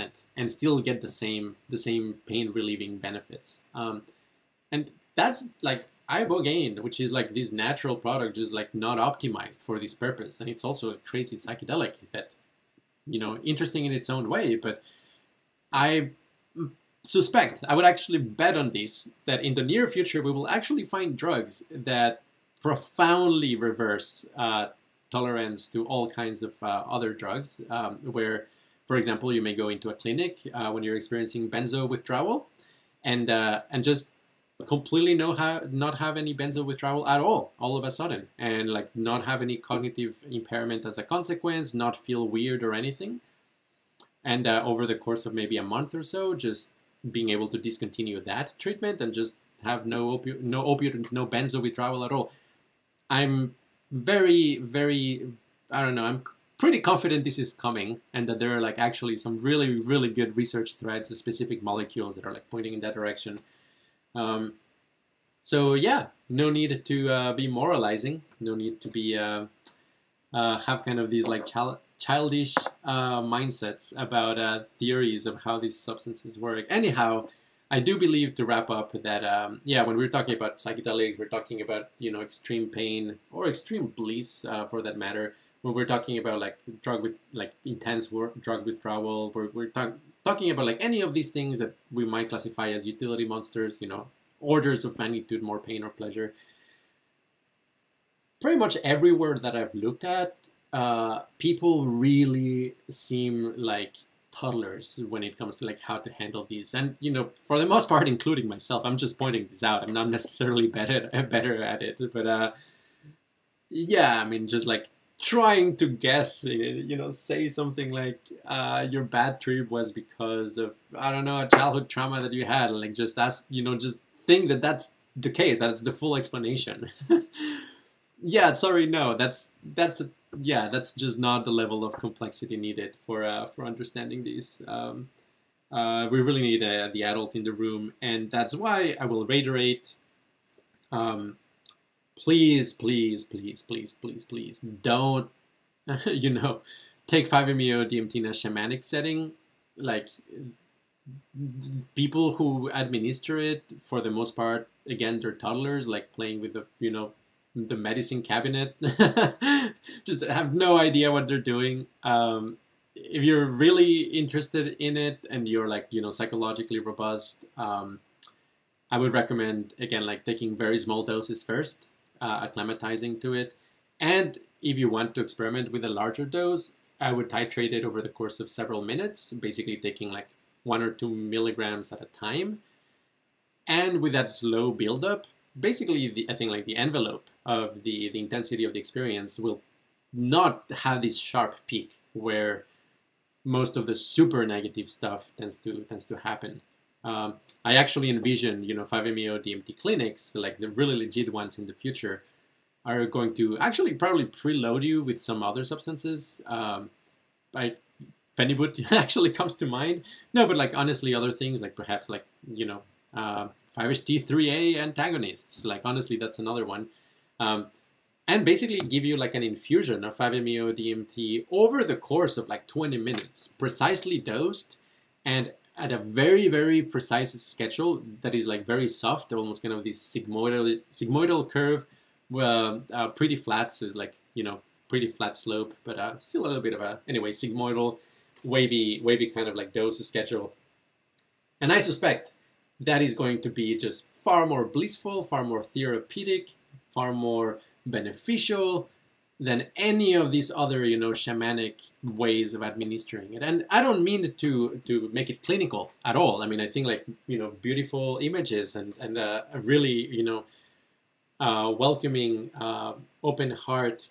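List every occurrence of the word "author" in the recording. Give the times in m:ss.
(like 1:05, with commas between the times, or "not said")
not said.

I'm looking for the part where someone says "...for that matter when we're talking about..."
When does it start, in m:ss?
1:24.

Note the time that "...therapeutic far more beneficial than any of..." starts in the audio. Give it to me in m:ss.
4:05.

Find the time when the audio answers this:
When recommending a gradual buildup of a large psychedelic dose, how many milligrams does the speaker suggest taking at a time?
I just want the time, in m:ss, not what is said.
3:00.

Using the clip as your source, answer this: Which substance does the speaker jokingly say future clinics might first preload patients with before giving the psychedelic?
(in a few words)
Phenibut.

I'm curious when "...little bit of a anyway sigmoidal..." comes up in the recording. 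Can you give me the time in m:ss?
3:56.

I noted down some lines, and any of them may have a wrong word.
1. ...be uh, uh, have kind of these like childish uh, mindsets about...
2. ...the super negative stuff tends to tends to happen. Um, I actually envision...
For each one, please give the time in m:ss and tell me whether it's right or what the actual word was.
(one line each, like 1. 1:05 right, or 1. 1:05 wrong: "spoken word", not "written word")
1. 1:08 right
2. 3:13 right.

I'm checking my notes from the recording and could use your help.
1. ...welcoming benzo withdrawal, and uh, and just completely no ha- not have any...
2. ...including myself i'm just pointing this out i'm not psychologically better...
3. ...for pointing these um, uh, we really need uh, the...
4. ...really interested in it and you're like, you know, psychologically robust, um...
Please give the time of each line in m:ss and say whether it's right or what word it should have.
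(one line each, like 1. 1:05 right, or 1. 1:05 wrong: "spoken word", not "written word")
1. 0:30 wrong: "experiencing", not "welcoming"
2. 1:48 wrong: "necessarily", not "psychologically"
3. 2:13 wrong: "understanding", not "pointing"
4. 2:43 right.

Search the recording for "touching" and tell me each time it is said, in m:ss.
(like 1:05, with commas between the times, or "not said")
not said.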